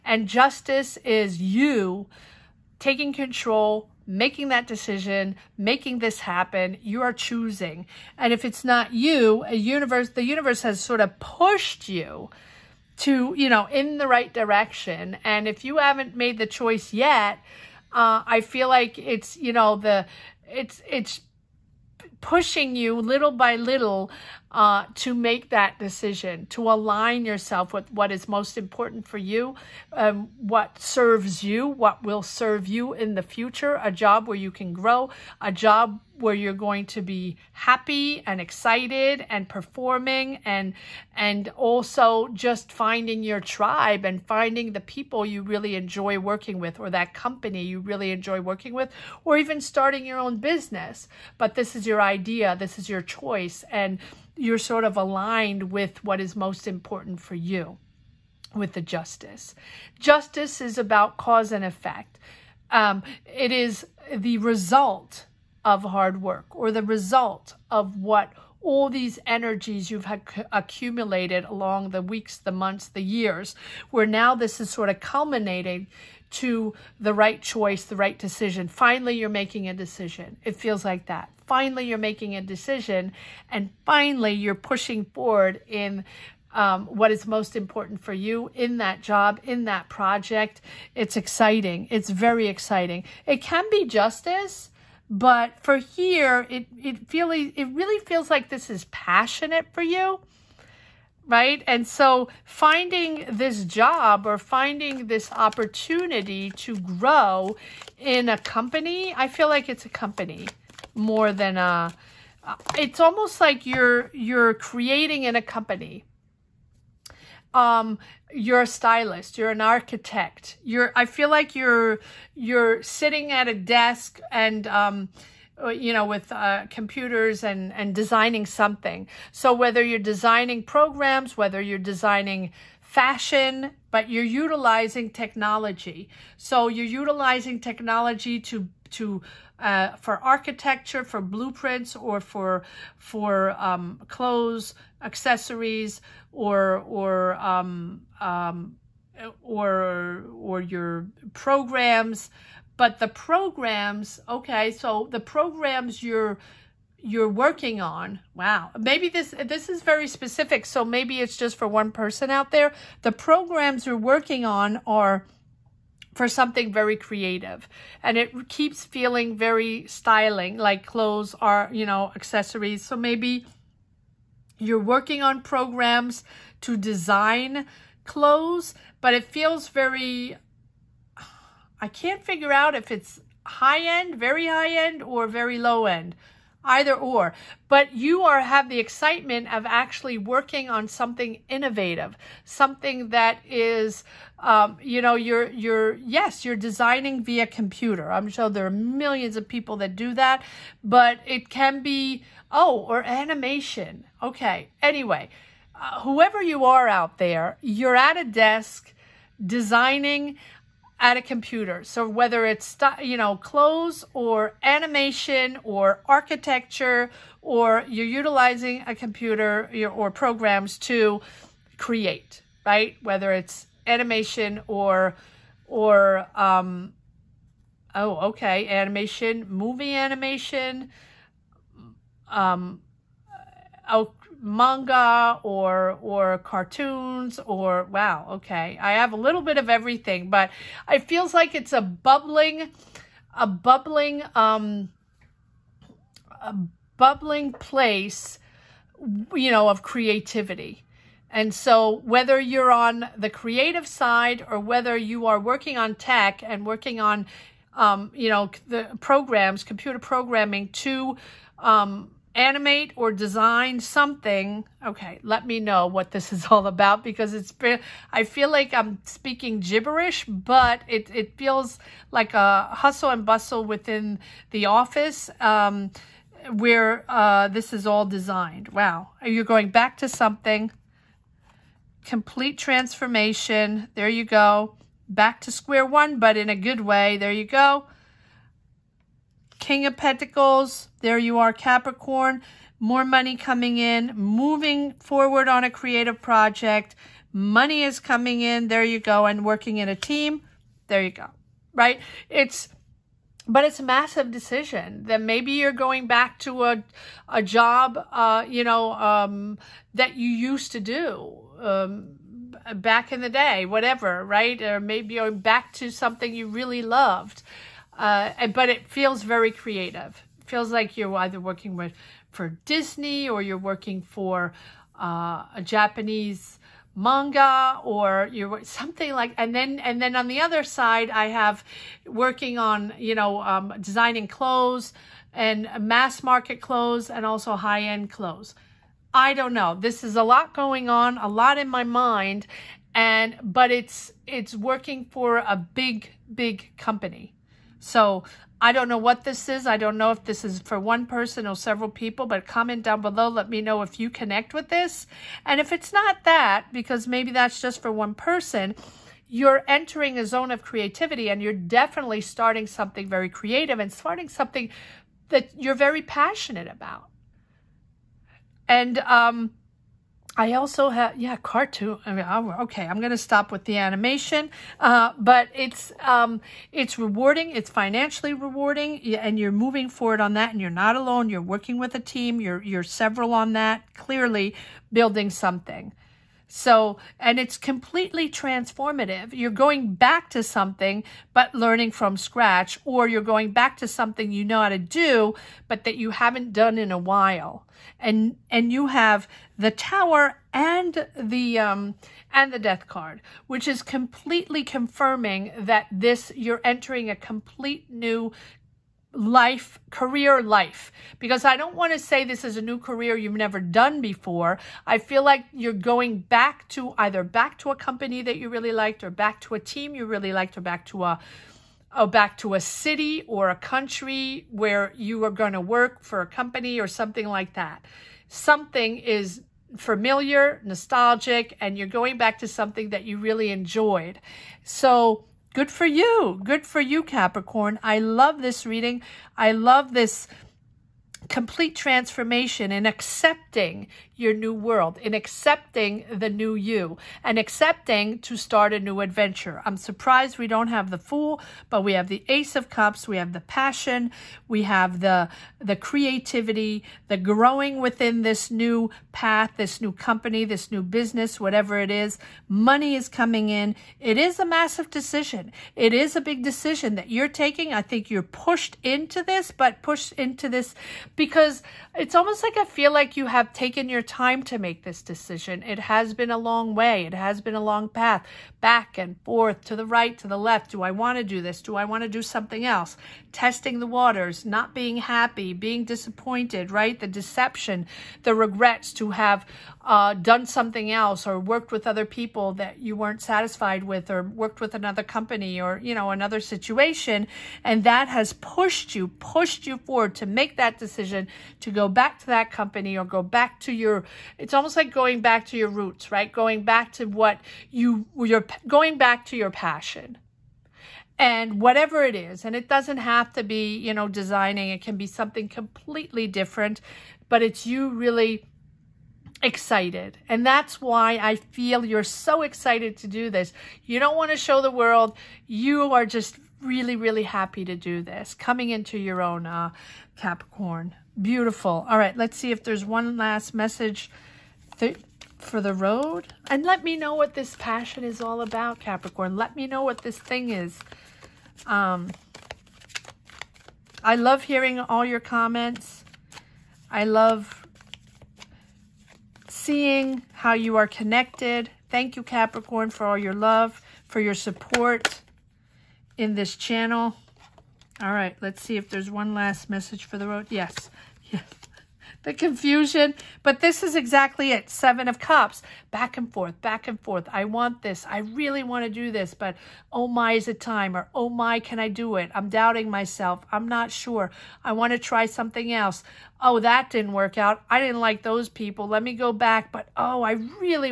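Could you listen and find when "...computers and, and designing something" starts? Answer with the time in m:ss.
2:06.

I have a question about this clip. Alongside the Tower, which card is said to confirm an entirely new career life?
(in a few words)
Death.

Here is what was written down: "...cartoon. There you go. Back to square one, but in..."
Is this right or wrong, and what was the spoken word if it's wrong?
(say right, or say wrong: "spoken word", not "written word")
wrong: "transformation", not "cartoon".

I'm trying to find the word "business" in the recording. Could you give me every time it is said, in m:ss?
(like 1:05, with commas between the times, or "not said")
0:50, 7:40.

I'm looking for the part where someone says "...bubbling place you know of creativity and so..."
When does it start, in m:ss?
4:06.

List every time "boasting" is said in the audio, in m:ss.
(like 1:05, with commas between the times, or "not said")
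not said.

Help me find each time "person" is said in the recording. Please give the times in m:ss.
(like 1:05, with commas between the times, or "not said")
2:41, 5:51, 5:58.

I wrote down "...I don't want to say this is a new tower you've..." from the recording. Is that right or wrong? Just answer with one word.
wrong.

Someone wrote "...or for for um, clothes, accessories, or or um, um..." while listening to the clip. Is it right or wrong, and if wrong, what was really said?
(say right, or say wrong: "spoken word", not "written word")
right.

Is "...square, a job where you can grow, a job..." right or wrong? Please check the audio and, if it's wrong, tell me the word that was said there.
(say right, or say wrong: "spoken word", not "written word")
wrong: "future", not "square".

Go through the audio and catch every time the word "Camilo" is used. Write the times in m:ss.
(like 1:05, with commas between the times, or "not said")
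not said.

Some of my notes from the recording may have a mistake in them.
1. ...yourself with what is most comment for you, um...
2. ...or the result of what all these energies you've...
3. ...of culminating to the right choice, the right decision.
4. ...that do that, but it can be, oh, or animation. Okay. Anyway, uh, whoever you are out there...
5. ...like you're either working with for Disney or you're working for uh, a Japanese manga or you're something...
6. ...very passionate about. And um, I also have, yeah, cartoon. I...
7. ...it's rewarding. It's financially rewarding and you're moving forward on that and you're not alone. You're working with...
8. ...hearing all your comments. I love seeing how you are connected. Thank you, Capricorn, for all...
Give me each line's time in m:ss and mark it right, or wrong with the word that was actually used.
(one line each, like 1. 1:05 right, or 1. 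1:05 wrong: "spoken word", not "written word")
1. 0:27 wrong: "important", not "comment"
2. 1:06 right
3. 1:14 right
4. 3:19 right
5. 5:20 right
6. 6:05 right
7. 6:16 right
8. 9:04 right.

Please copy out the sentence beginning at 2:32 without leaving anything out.
But the programs, okay, so the programs you're you're working on.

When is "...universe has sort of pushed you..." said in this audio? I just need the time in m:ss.
0:10.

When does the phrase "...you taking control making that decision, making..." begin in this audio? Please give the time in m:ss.
0:01.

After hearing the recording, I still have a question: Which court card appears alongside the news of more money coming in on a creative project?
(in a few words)
King of Pentacles.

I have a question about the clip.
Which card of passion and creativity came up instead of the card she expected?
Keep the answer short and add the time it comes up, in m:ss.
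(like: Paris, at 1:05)
Ace of Cups, at 7:32.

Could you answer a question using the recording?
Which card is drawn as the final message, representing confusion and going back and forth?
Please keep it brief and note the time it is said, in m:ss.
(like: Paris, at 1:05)
Seven of Cups, at 9:24.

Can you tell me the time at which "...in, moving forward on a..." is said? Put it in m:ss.
4:53.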